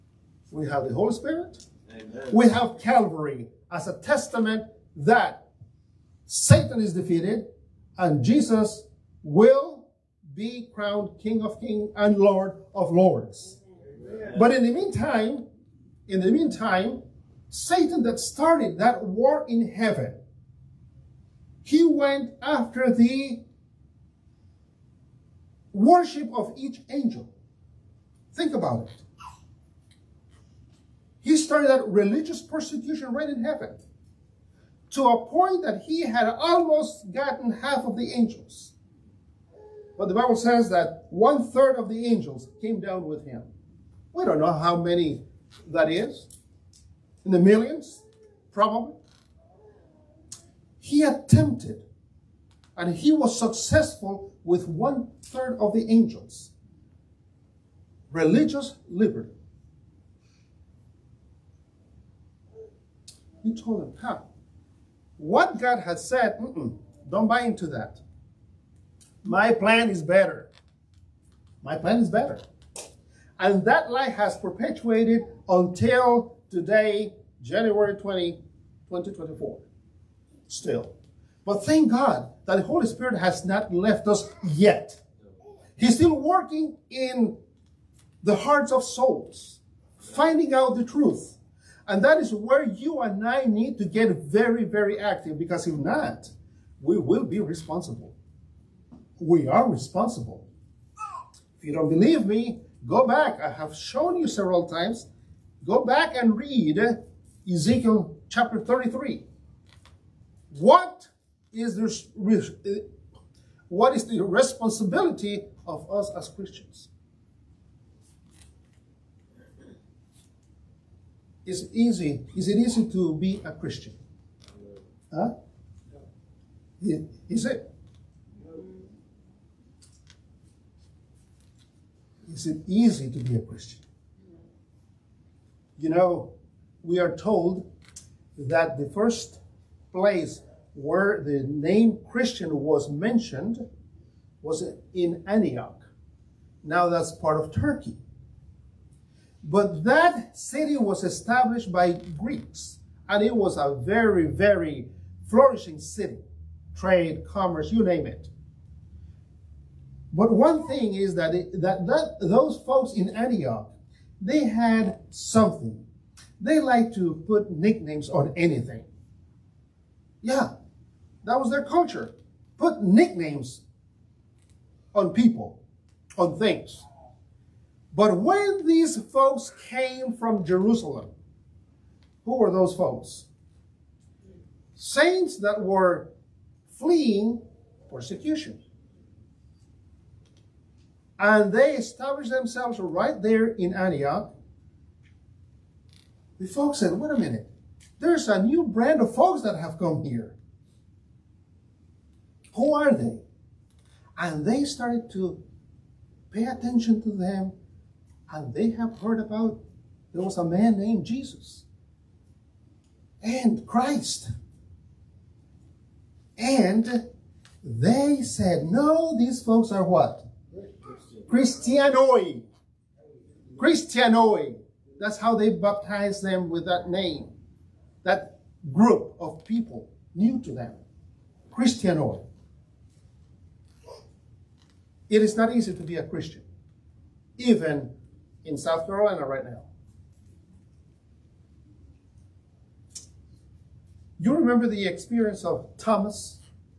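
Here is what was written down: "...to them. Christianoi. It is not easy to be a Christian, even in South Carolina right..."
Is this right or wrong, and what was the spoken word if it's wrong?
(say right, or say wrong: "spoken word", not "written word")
right.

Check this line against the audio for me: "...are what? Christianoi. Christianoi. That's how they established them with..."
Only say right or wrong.
wrong.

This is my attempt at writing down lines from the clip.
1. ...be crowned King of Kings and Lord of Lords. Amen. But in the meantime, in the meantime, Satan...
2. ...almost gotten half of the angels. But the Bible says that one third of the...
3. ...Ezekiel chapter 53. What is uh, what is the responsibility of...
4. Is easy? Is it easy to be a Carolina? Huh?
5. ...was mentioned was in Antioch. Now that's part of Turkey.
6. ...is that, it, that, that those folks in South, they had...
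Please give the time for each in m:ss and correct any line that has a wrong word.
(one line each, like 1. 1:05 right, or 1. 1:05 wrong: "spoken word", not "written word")
1. 0:10 right
2. 0:36 right
3. 1:47 wrong: "33", not "53"
4. 2:01 wrong: "Christian", not "Carolina"
5. 2:22 right
6. 2:40 wrong: "Antioch", not "South".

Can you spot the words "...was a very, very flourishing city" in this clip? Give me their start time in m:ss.
2:33.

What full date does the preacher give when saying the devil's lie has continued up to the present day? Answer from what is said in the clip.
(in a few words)
January 20, 2024.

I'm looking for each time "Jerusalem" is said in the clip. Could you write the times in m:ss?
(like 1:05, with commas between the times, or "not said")
3:00.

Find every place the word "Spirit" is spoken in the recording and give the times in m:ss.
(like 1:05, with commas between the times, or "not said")
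0:01, 1:22.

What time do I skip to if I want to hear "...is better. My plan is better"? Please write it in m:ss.
1:09.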